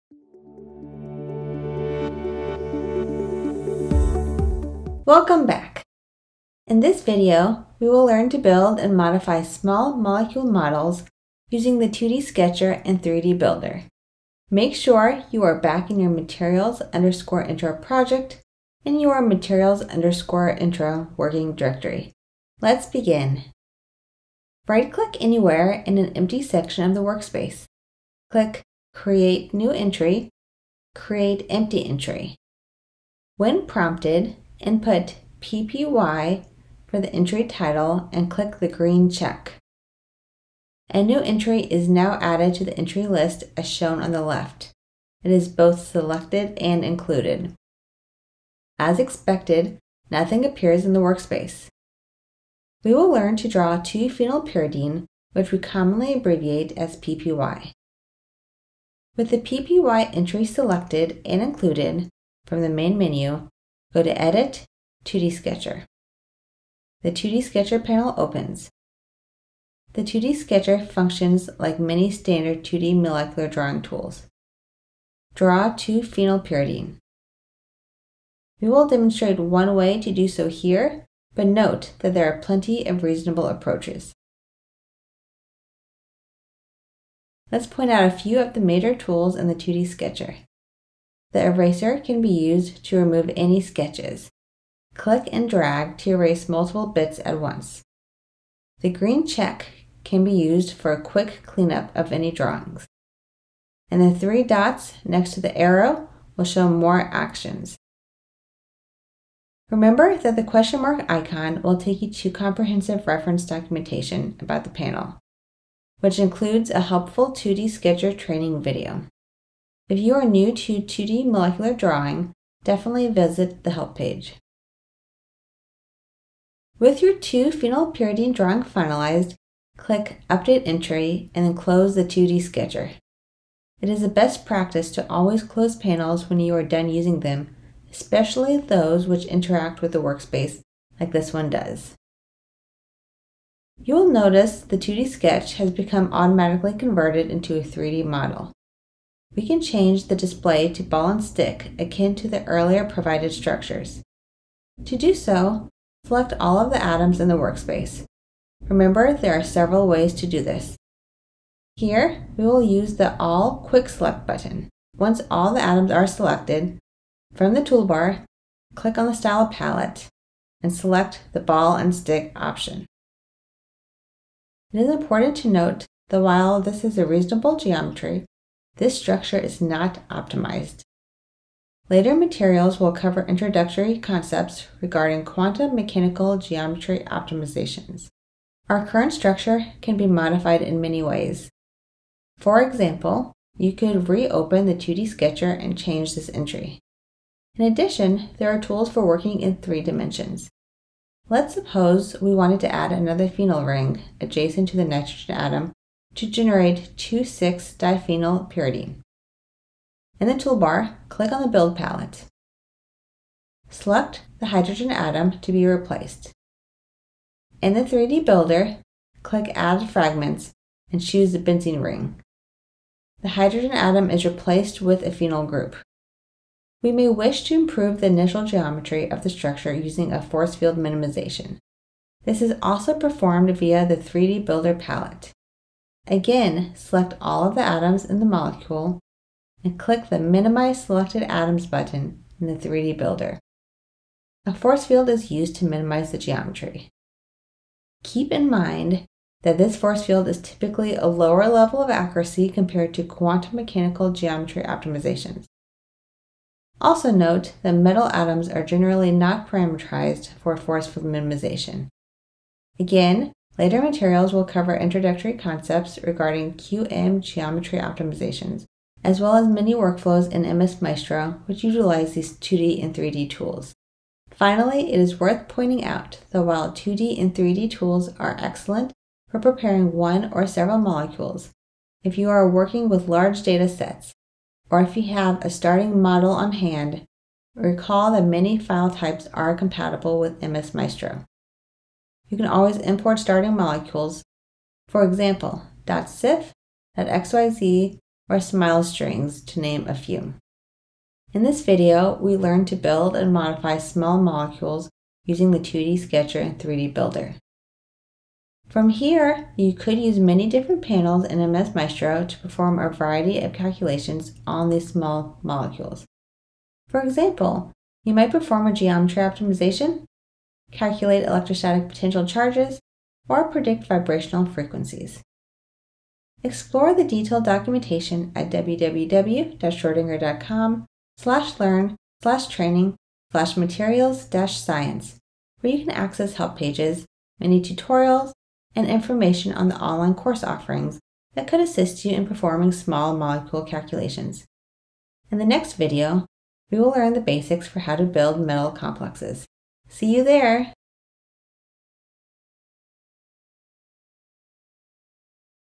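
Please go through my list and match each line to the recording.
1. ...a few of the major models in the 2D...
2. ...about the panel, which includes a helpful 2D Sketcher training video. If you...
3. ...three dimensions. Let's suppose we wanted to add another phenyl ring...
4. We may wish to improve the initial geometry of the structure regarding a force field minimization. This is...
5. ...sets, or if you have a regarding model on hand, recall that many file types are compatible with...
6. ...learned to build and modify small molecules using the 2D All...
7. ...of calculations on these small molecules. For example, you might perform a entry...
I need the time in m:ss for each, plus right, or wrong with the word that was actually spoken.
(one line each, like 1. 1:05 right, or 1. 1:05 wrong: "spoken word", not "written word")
1. 1:28 wrong: "tools", not "models"
2. 1:54 right
3. 3:19 right
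4. 3:46 wrong: "using", not "regarding"
5. 4:43 wrong: "starting", not "regarding"
6. 5:02 wrong: "Sketcher", not "All"
7. 5:13 wrong: "geometry", not "entry".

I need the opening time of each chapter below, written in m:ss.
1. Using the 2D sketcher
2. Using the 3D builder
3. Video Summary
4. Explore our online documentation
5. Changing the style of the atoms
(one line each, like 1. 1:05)
1. 0:24
2. 3:20
3. 5:00
4. 5:26
5. 2:30.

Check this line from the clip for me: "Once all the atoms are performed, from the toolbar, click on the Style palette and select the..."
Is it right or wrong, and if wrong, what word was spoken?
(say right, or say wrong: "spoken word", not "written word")
wrong: "selected", not "performed".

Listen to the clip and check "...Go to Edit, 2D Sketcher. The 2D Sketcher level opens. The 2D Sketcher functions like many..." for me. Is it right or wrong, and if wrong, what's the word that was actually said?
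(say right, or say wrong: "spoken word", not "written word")
wrong: "panel", not "level".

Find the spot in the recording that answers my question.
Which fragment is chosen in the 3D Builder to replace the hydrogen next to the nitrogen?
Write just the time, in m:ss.
3:41.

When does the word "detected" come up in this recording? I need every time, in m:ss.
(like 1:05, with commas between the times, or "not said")
not said.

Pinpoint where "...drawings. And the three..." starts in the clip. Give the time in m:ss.
1:42.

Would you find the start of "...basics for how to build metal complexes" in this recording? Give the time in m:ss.
5:47.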